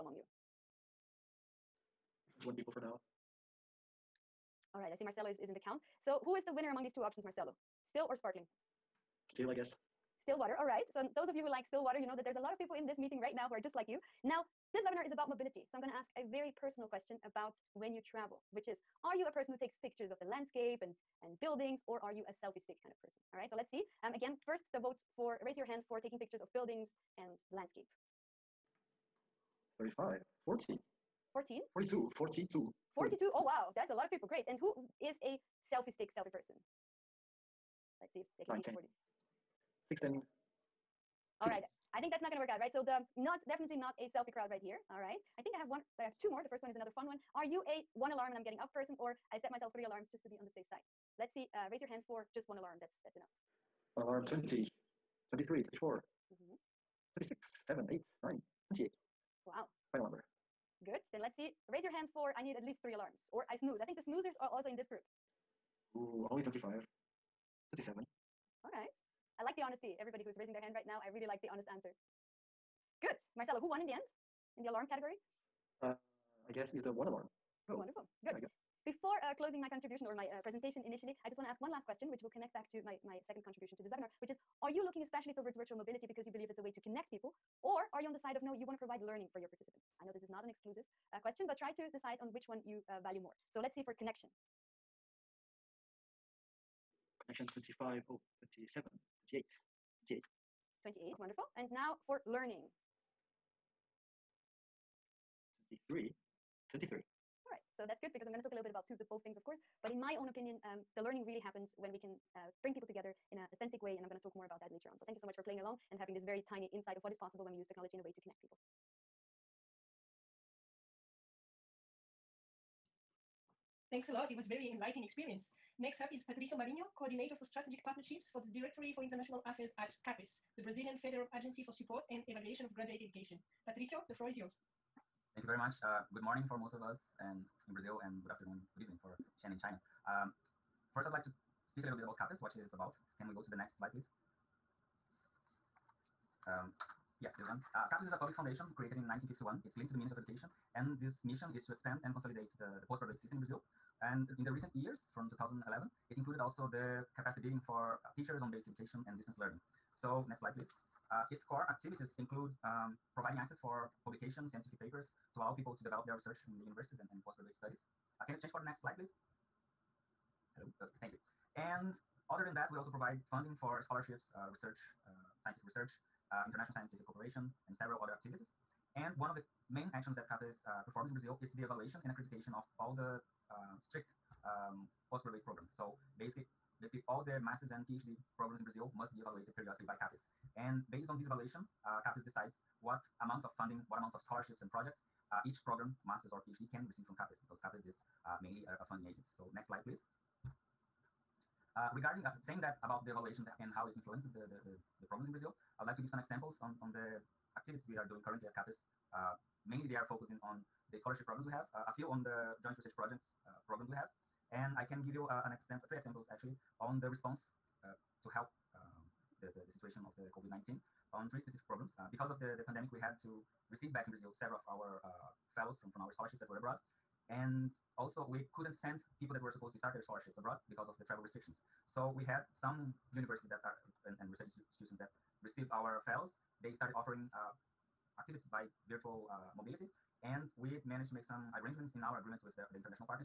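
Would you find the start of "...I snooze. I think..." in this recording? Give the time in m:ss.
1:03.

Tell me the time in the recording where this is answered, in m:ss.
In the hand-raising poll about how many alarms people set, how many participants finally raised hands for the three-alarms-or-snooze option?
1:07.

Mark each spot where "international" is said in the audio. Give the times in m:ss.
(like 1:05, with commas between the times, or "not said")
2:09, 2:56.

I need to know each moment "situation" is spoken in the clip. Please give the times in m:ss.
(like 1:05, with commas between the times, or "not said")
3:39.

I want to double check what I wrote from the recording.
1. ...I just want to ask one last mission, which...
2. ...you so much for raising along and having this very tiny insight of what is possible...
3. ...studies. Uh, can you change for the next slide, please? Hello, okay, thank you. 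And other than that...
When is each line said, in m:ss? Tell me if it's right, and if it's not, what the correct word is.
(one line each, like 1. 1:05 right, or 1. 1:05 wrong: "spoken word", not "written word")
1. 1:21 wrong: "question", not "mission"
2. 1:55 wrong: "playing", not "raising"
3. 2:47 right.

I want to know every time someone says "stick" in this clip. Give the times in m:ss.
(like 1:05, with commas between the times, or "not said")
0:22, 0:35.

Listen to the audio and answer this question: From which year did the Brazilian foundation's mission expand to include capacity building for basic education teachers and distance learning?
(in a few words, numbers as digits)
2011.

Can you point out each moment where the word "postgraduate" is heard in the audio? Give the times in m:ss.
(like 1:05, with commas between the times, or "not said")
2:32, 2:47, 3:05.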